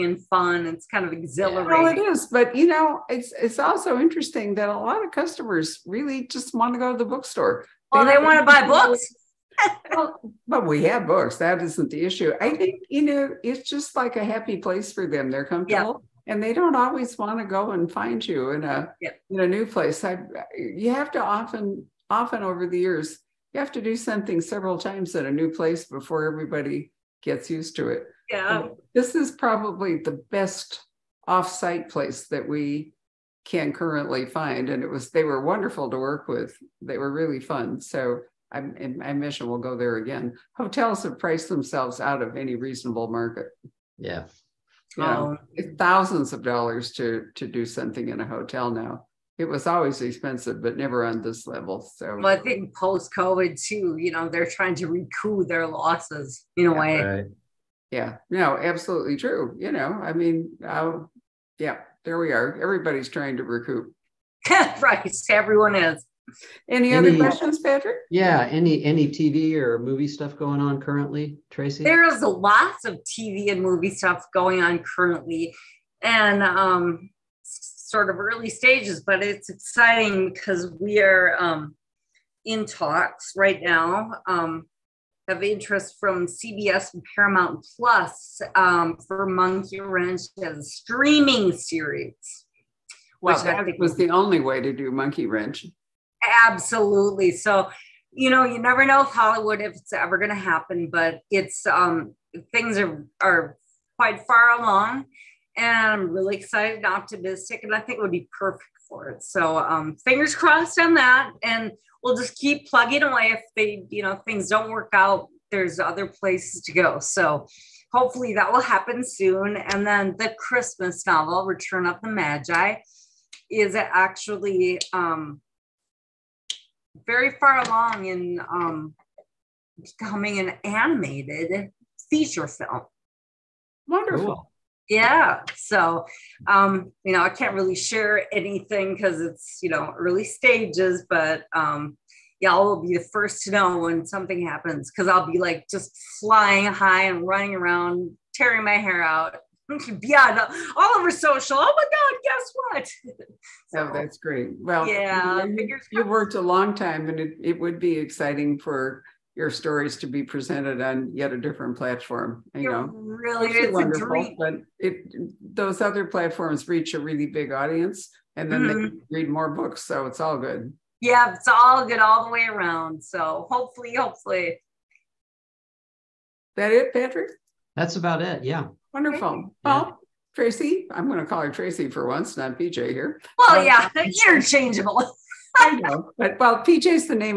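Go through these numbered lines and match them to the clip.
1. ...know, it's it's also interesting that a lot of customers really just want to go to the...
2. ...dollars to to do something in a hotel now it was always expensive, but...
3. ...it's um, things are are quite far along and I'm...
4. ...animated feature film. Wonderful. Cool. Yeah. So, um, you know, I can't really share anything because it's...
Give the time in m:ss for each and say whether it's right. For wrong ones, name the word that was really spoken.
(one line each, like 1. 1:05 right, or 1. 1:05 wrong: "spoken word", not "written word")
1. 0:02 right
2. 0:46 right
3. 1:41 right
4. 2:10 right.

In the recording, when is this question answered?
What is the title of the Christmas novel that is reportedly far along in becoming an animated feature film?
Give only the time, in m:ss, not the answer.
2:01.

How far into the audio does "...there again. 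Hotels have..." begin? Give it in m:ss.
0:39.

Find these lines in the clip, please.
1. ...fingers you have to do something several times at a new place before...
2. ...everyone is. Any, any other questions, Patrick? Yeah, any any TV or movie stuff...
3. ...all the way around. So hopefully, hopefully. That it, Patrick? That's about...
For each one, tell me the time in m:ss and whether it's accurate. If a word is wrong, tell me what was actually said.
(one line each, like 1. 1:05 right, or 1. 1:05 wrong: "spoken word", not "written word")
1. 0:22 wrong: "years", not "fingers"
2. 1:05 right
3. 2:51 right.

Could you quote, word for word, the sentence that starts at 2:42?
You know, really it's wonderful, but it those other platforms reach a really big audience, and then mm-hmm.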